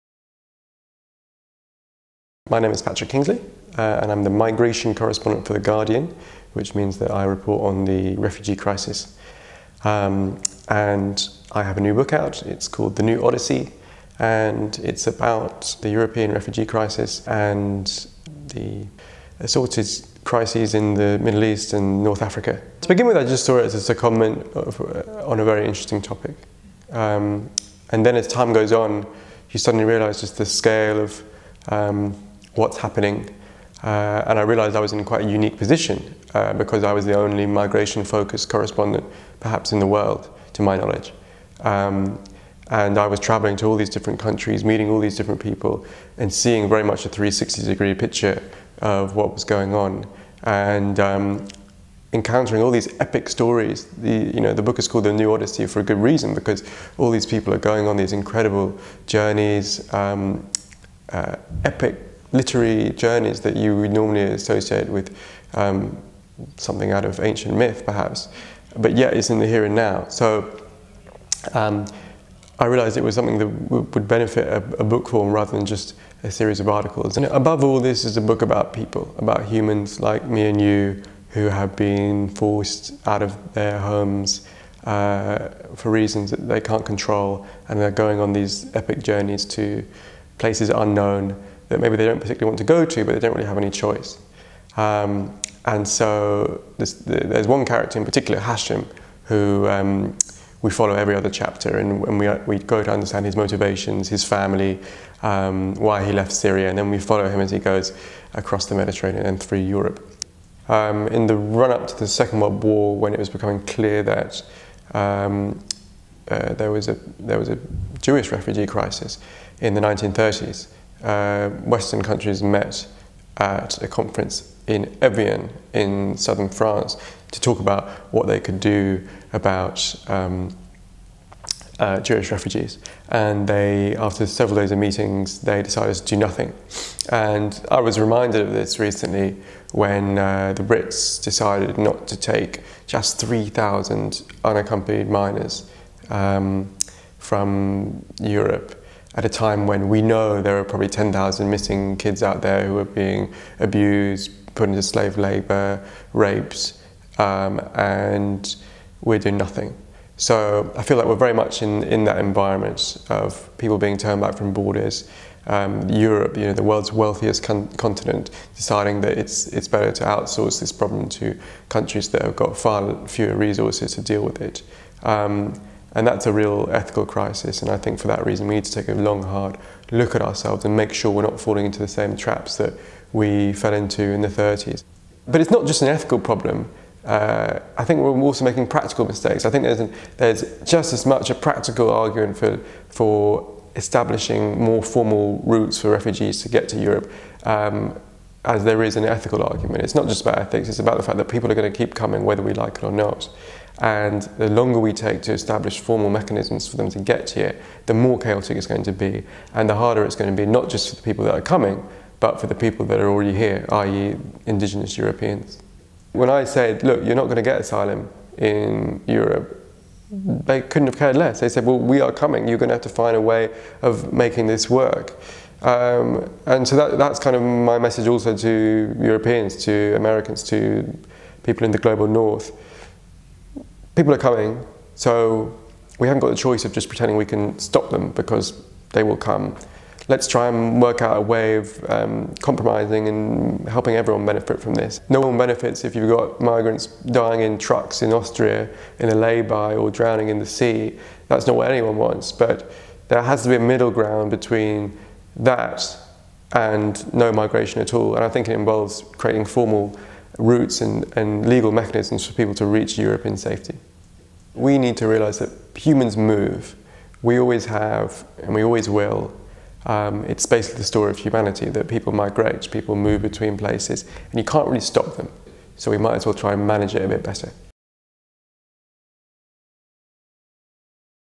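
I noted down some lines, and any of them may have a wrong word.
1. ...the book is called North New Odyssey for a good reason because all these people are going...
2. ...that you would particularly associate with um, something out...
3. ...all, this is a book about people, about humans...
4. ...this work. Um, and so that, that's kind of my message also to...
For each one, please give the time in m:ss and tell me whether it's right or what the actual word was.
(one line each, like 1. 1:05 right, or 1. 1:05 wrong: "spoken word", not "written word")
1. 0:54 wrong: "The", not "North"
2. 1:03 wrong: "normally", not "particularly"
3. 1:17 right
4. 3:44 right.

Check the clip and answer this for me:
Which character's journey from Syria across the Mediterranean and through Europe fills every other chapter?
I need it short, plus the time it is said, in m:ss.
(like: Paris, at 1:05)
Hashim, at 1:38.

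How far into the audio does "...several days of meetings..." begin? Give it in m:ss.
2:14.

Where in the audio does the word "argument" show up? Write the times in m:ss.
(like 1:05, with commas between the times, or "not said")
3:11, 3:19.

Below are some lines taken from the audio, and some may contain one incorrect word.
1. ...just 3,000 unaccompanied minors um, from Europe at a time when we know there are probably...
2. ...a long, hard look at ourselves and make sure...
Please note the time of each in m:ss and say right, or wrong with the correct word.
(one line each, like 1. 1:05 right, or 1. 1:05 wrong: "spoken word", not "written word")
1. 2:22 right
2. 2:58 right.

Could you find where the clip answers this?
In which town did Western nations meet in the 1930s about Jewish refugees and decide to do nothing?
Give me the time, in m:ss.
2:05.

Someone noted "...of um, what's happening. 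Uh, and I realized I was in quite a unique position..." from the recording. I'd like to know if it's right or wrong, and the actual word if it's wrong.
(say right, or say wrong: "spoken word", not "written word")
right.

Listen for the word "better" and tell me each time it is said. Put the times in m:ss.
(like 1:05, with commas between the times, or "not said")
2:49, 4:37.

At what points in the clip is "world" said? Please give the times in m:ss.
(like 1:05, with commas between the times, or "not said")
0:39, 1:52, 2:46.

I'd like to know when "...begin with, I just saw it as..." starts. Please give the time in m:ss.
0:22.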